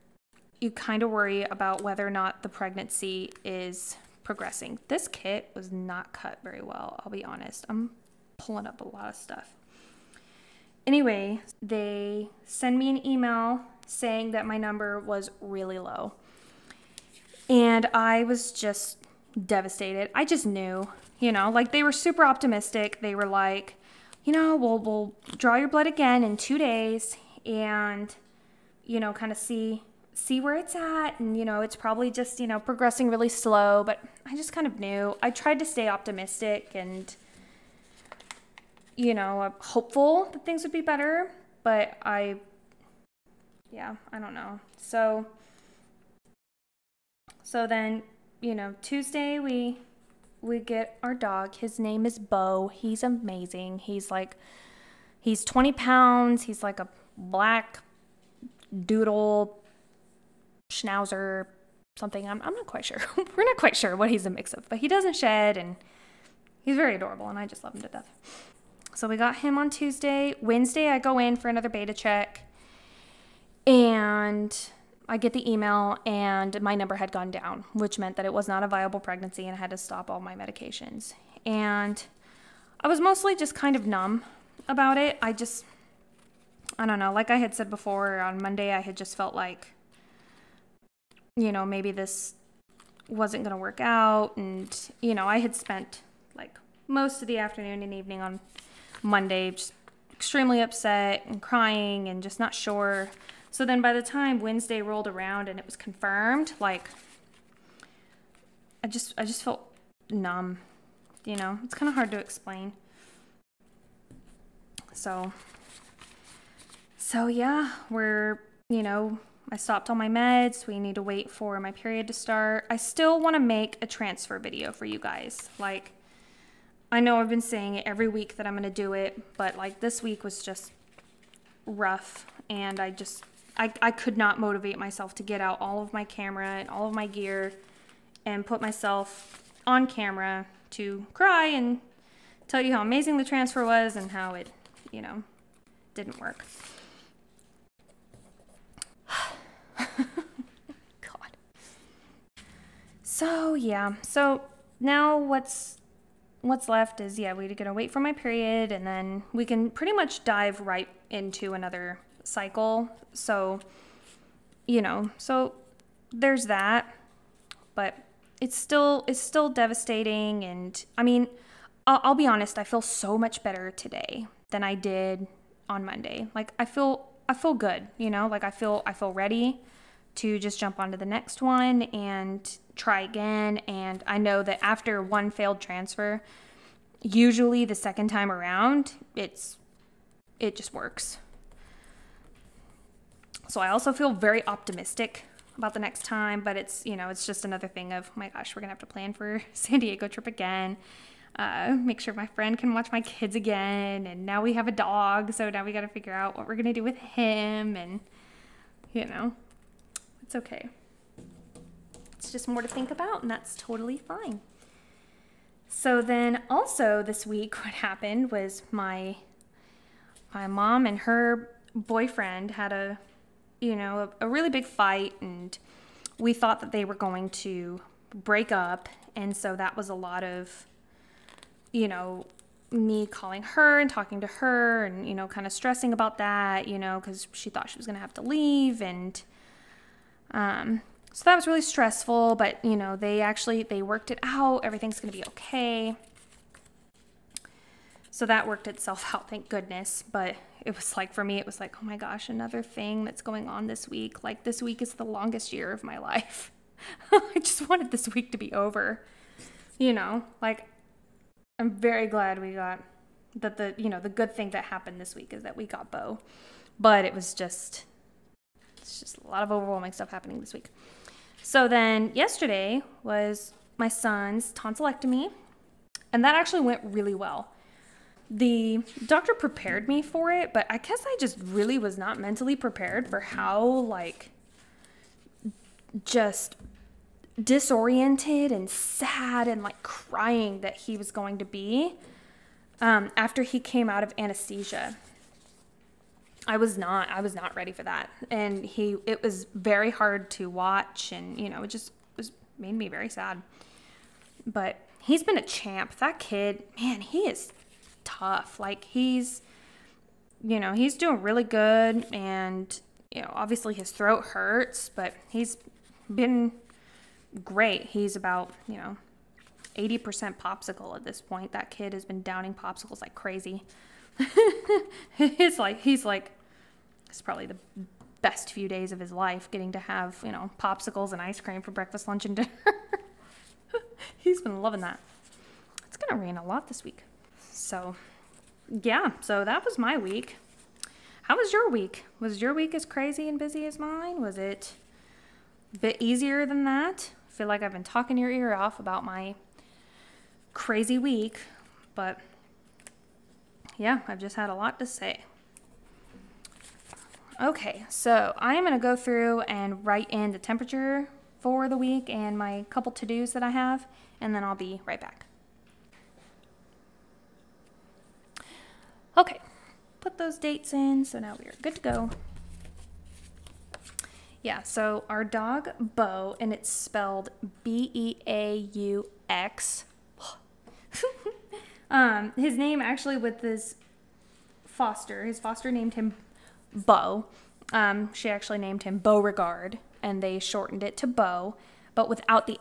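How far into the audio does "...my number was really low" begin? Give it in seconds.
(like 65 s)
14 s.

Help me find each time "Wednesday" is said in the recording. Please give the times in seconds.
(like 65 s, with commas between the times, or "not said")
70 s, 104 s.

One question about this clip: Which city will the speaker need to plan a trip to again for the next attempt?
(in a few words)
San Diego.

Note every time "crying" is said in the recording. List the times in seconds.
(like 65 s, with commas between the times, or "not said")
101 s, 289 s.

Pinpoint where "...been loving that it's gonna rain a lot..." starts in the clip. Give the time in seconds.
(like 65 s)
334 s.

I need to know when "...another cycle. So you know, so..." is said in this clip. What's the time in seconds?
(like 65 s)
161 s.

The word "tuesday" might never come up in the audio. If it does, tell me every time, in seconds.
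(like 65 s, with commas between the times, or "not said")
48 s, 69 s.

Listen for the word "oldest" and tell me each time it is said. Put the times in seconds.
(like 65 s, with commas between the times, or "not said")
not said.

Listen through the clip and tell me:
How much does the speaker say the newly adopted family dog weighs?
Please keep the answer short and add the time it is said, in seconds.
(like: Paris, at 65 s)
20 pounds, at 55 s.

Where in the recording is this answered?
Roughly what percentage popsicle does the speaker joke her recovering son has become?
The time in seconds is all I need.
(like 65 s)
319 s.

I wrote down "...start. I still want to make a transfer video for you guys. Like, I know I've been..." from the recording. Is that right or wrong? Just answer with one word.
right.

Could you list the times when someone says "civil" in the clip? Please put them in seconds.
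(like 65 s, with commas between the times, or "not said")
not said.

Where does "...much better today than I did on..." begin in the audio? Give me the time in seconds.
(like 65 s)
173 s.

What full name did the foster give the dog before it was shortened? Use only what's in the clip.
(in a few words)
Beauregard.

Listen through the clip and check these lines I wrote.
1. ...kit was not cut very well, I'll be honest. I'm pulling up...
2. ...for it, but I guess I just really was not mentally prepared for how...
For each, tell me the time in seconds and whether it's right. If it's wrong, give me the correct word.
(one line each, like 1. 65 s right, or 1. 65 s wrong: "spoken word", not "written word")
1. 5 s right
2. 280 s right.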